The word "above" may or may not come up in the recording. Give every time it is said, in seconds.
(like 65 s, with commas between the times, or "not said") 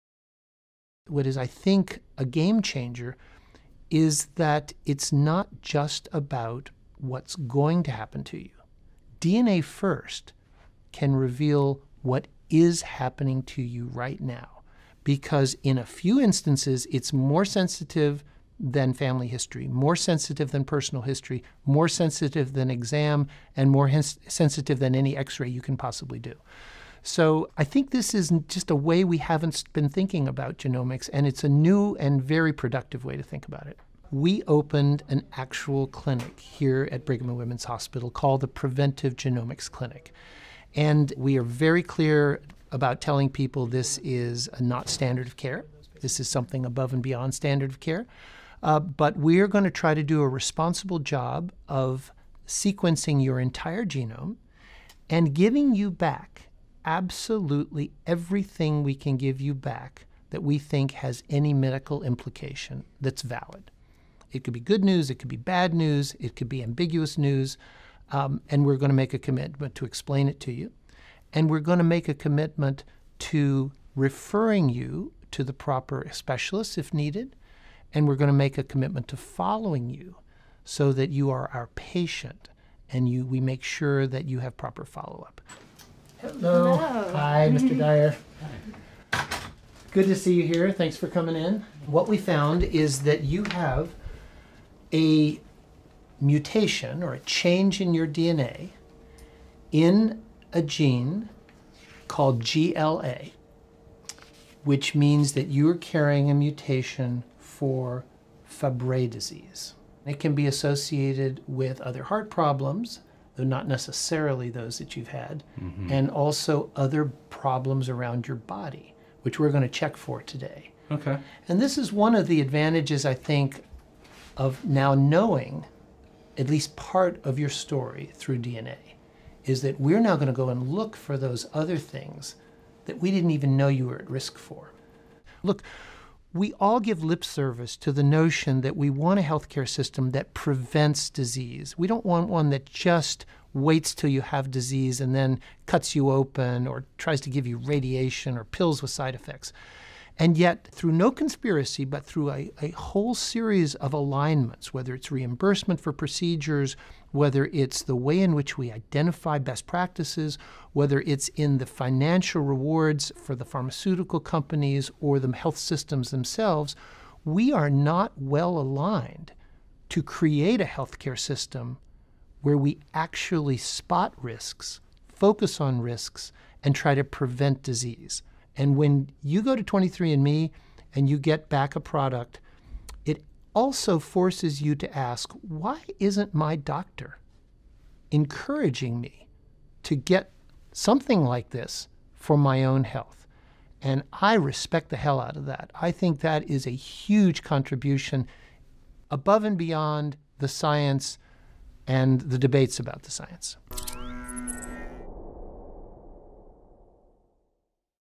46 s, 199 s.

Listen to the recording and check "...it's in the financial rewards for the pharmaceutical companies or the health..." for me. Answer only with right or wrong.
right.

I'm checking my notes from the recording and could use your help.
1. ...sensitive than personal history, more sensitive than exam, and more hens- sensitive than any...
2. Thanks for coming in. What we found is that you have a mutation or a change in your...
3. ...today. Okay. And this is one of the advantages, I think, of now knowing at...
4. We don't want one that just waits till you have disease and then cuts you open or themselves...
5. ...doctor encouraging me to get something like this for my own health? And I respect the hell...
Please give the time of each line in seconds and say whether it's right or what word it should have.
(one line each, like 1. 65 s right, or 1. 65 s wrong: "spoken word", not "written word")
1. 19 s right
2. 90 s right
3. 120 s right
4. 141 s wrong: "tries", not "themselves"
5. 186 s right.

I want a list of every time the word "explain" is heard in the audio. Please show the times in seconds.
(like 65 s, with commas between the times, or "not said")
69 s.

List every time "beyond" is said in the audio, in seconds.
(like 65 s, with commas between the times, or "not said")
47 s, 199 s.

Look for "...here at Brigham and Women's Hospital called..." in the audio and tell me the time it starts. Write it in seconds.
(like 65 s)
36 s.